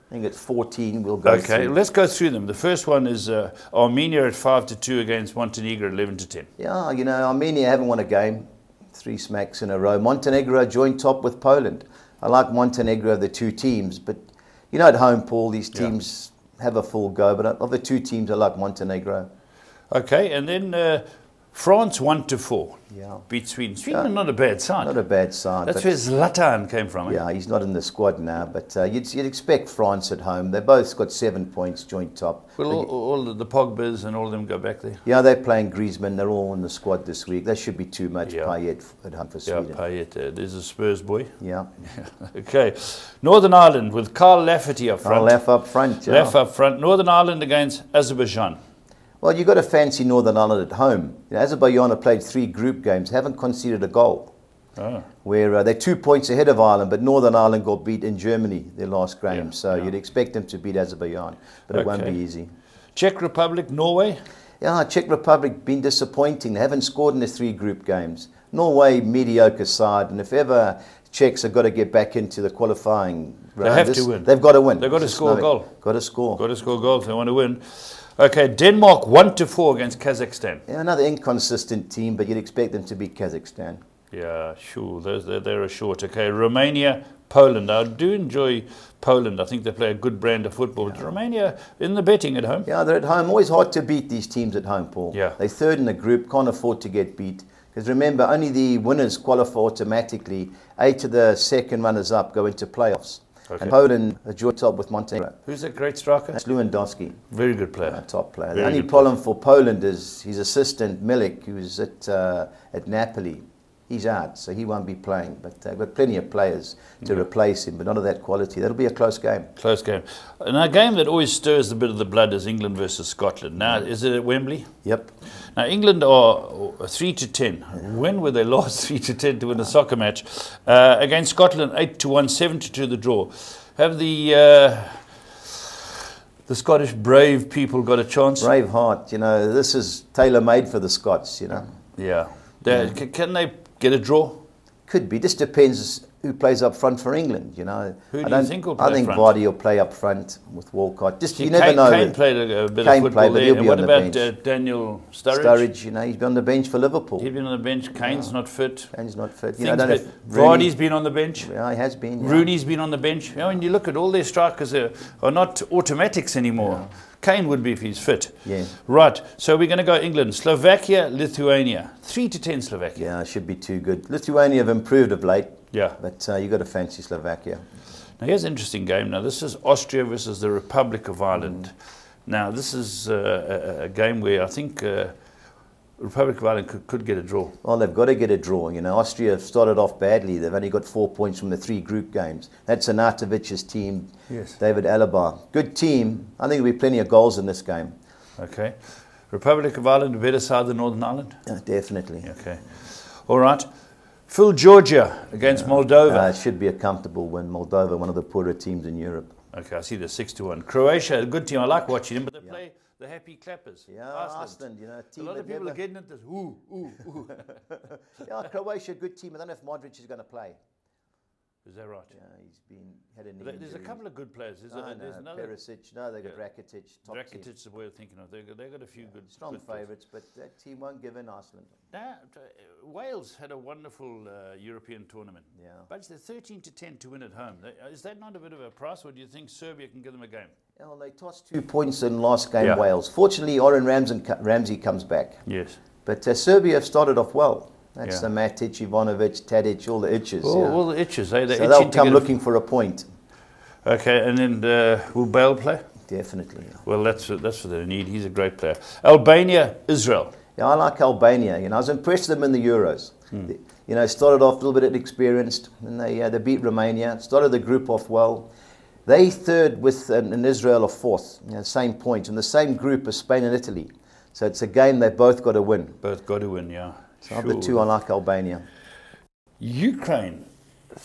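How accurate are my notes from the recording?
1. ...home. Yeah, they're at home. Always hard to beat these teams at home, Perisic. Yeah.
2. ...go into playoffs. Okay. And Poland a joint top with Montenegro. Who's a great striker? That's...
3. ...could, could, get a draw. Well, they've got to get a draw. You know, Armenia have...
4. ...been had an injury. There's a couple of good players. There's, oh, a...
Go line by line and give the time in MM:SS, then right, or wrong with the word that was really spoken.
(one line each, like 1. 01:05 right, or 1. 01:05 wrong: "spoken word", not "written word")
1. 01:32 wrong: "Paul", not "Perisic"
2. 01:42 right
3. 03:06 wrong: "Austria", not "Armenia"
4. 03:42 right.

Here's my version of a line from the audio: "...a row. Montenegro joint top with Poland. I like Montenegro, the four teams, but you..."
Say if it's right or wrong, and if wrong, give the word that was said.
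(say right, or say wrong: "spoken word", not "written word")
wrong: "two", not "four".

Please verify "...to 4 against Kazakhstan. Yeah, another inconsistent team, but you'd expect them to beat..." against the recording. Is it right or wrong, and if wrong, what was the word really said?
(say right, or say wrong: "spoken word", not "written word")
right.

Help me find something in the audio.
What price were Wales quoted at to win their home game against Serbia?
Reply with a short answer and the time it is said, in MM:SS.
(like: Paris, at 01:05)
13 to 10, at 03:56.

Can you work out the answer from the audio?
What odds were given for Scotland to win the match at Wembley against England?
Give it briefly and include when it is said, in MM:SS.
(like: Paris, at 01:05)
8 to 1, at 02:11.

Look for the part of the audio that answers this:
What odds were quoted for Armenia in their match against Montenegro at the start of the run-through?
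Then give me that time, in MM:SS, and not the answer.
00:04.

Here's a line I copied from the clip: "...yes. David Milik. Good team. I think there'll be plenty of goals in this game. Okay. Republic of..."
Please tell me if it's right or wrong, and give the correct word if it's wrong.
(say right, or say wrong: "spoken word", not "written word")
wrong: "Alaba", not "Milik".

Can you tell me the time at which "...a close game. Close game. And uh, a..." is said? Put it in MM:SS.
01:58.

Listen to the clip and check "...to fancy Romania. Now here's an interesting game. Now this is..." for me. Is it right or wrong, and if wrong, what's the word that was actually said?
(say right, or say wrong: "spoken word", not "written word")
wrong: "Slovakia", not "Romania".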